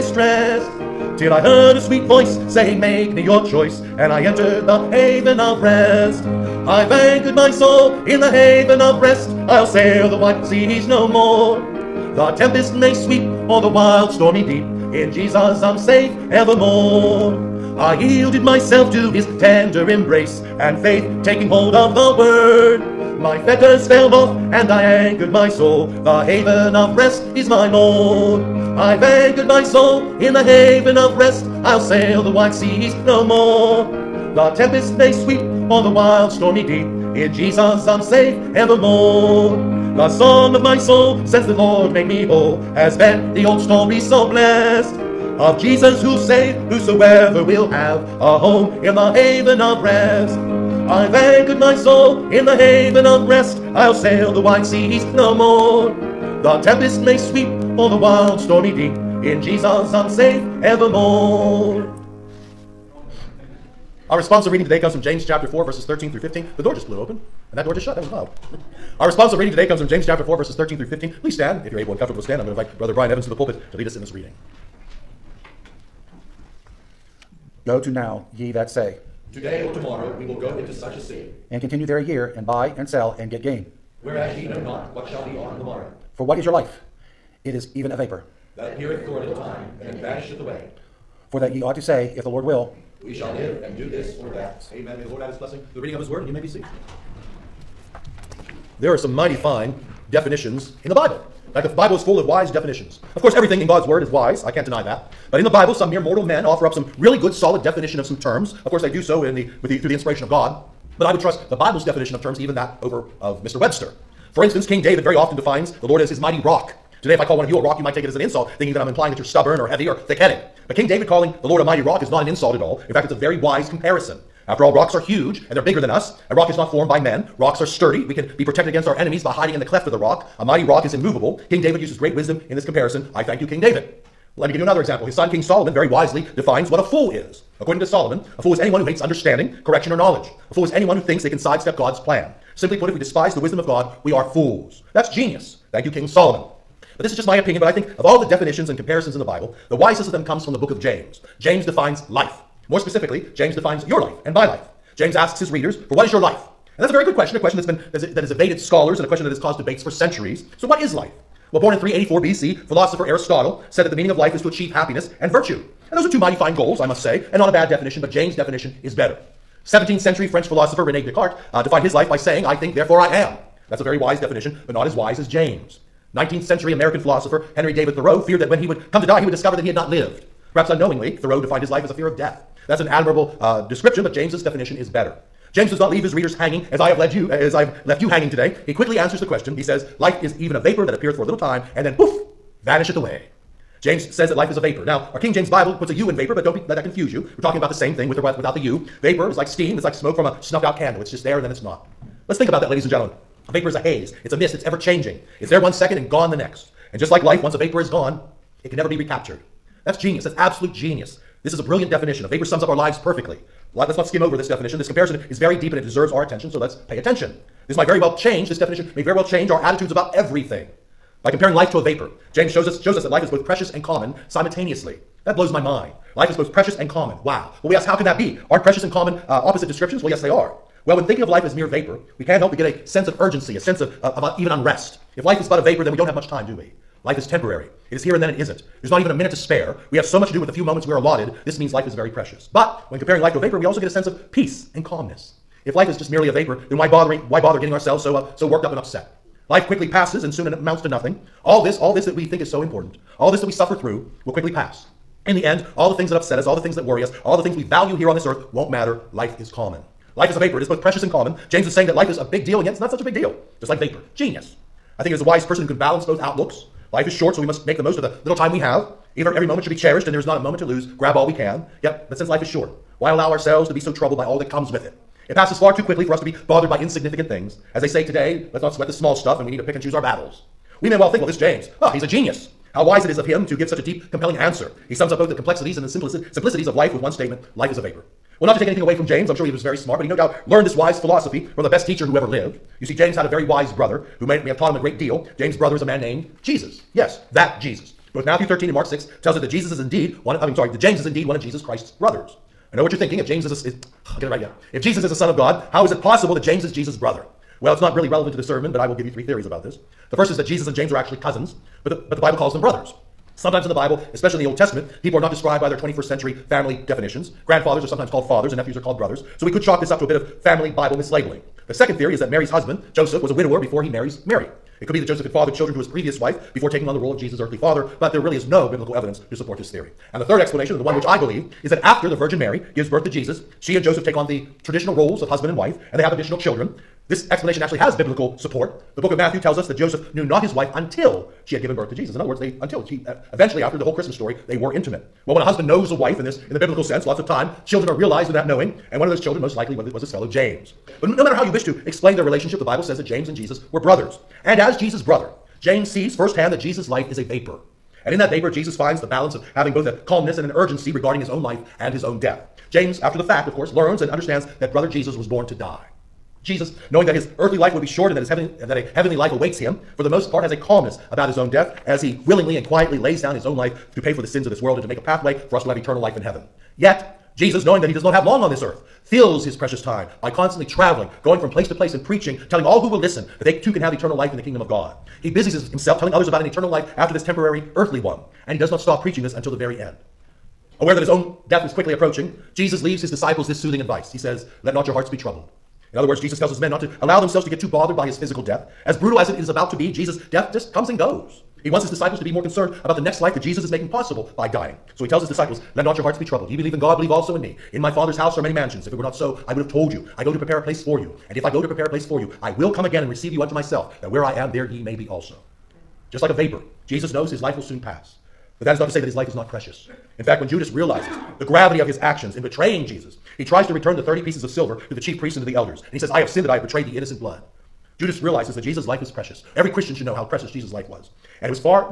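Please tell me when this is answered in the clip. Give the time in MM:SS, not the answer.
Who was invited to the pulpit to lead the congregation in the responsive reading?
01:12.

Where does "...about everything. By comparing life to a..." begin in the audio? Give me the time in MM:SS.
03:39.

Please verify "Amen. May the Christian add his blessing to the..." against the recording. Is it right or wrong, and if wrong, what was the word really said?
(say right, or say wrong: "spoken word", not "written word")
wrong: "Lord", not "Christian".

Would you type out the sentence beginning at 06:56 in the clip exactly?
Just like a vapor, Jesus knows his life will soon pass.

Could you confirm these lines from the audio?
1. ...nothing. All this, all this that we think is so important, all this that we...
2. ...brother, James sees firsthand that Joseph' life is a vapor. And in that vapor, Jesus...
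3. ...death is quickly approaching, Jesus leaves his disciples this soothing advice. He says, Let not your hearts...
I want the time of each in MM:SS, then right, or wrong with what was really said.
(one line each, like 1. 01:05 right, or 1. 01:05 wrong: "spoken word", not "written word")
1. 04:10 right
2. 05:55 wrong: "Jesus", not "Joseph"
3. 06:31 right.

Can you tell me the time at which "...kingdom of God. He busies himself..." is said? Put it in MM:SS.
06:24.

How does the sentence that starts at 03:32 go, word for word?
A vapor sums up our lives perfectly.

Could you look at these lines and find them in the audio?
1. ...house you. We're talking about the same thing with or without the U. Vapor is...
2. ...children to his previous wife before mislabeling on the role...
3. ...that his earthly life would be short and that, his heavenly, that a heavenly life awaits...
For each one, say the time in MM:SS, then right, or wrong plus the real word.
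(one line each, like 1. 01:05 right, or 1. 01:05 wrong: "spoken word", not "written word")
1. 03:16 wrong: "confuse", not "house"
2. 05:25 wrong: "taking", not "mislabeling"
3. 06:07 right.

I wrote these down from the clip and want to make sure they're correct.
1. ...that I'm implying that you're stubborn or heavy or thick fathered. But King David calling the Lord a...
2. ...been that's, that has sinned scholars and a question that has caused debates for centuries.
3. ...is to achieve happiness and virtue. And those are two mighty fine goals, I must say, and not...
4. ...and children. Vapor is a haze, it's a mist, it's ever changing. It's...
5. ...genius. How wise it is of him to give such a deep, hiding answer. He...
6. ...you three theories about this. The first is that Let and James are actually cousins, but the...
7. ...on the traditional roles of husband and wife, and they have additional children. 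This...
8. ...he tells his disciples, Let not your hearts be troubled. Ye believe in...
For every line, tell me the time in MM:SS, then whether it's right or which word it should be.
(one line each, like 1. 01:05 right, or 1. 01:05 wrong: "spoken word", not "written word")
1. 01:58 wrong: "headed", not "fathered"
2. 02:37 wrong: "evaded", not "sinned"
3. 02:44 right
4. 03:22 wrong: "gentlemen", not "children"
5. 04:42 wrong: "compelling", not "hiding"
6. 05:09 wrong: "Jesus", not "Let"
7. 05:34 right
8. 06:45 right.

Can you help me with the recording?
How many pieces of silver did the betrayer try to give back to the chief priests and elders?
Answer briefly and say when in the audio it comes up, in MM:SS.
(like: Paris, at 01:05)
30, at 07:04.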